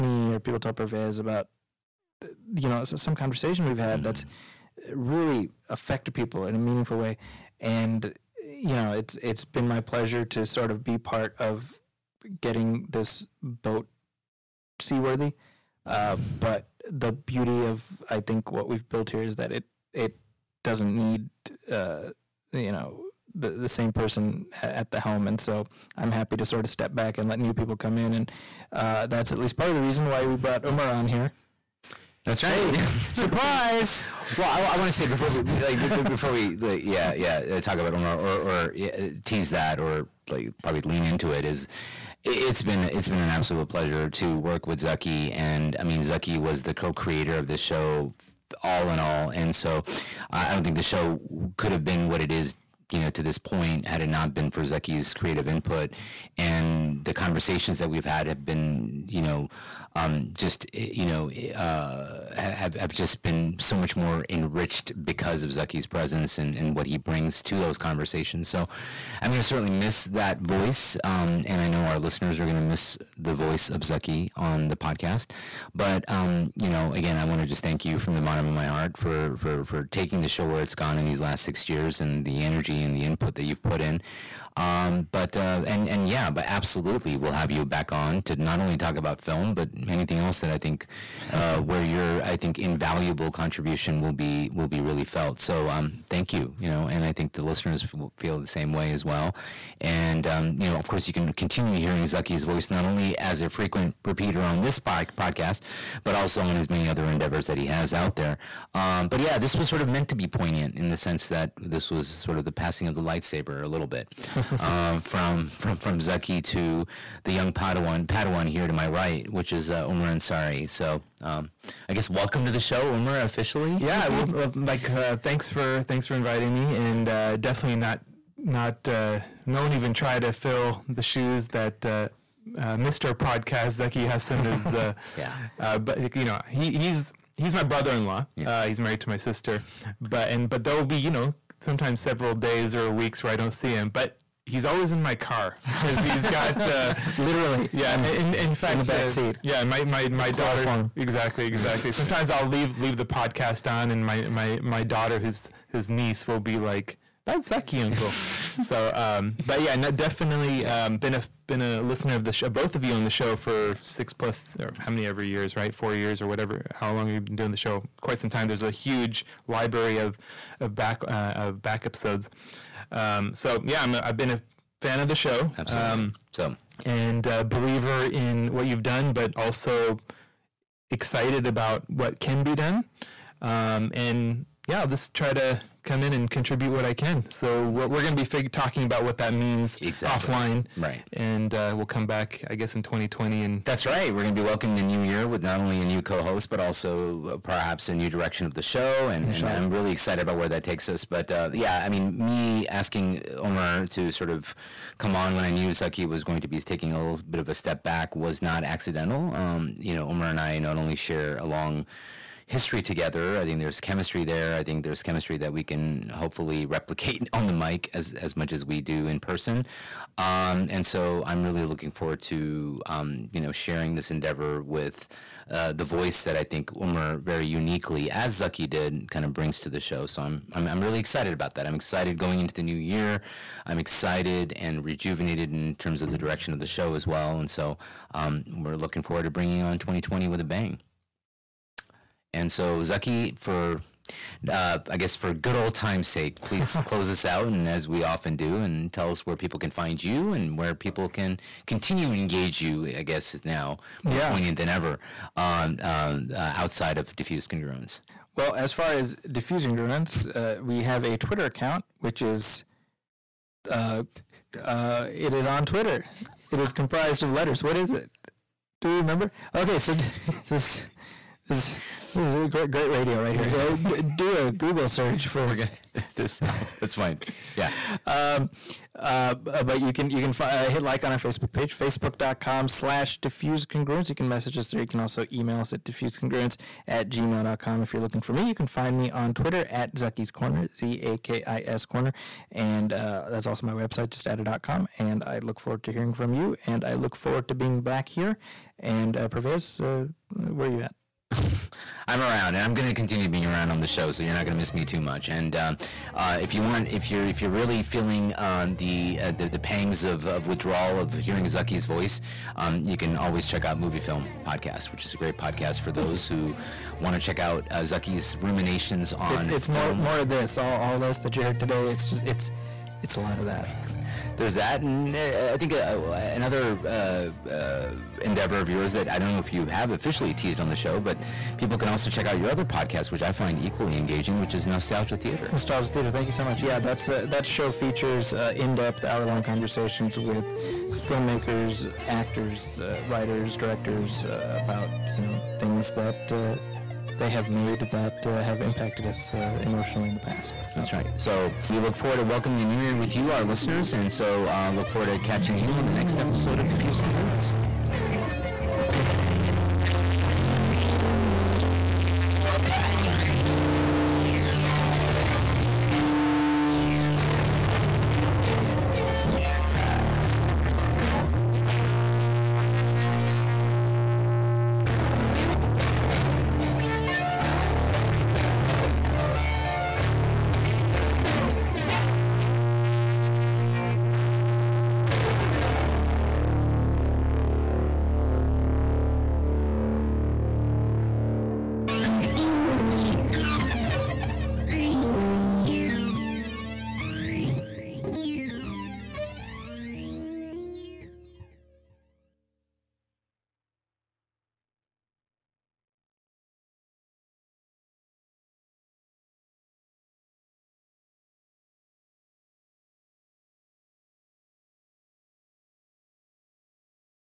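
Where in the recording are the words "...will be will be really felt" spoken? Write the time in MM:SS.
01:33.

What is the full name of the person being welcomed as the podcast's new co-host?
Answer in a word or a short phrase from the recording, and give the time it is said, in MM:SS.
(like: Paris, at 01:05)
Omar Ansari, at 01:59.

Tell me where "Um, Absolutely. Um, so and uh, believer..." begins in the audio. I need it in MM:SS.
02:55.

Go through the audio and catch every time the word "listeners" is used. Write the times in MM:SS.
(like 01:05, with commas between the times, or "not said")
01:11, 01:37, 02:41, 05:53.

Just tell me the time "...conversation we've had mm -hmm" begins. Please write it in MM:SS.
00:03.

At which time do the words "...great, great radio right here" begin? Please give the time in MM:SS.
04:32.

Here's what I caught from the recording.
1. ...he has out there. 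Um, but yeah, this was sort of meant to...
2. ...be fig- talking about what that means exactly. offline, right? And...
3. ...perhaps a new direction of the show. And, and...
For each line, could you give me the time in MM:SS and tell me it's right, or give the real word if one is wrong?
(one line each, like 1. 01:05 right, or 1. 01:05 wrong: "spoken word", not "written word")
1. 01:47 right
2. 03:08 right
3. 03:17 right.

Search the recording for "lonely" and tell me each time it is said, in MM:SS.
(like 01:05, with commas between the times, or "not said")
not said.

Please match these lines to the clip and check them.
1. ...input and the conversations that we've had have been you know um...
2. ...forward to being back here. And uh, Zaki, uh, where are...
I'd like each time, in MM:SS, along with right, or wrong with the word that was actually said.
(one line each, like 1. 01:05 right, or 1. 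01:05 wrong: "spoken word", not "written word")
1. 00:55 right
2. 04:57 wrong: "Parvez", not "Zaki".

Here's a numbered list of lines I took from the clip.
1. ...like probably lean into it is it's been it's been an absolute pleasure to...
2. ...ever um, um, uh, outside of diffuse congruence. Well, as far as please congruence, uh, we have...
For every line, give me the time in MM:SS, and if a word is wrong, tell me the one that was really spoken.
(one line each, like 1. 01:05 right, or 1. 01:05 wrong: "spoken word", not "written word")
1. 00:40 right
2. 04:14 wrong: "diffuse", not "please".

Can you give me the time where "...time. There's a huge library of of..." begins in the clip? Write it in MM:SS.
02:48.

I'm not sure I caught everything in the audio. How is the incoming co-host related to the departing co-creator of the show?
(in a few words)
brother-in-law.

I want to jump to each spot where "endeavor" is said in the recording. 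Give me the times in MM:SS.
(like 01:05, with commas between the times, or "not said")
01:47, 03:44, 05:28.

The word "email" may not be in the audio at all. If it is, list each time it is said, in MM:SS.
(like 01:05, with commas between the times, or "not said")
04:45.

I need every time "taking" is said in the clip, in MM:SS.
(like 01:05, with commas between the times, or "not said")
01:19, 03:26.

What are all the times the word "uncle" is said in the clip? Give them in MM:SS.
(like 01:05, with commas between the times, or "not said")
02:37.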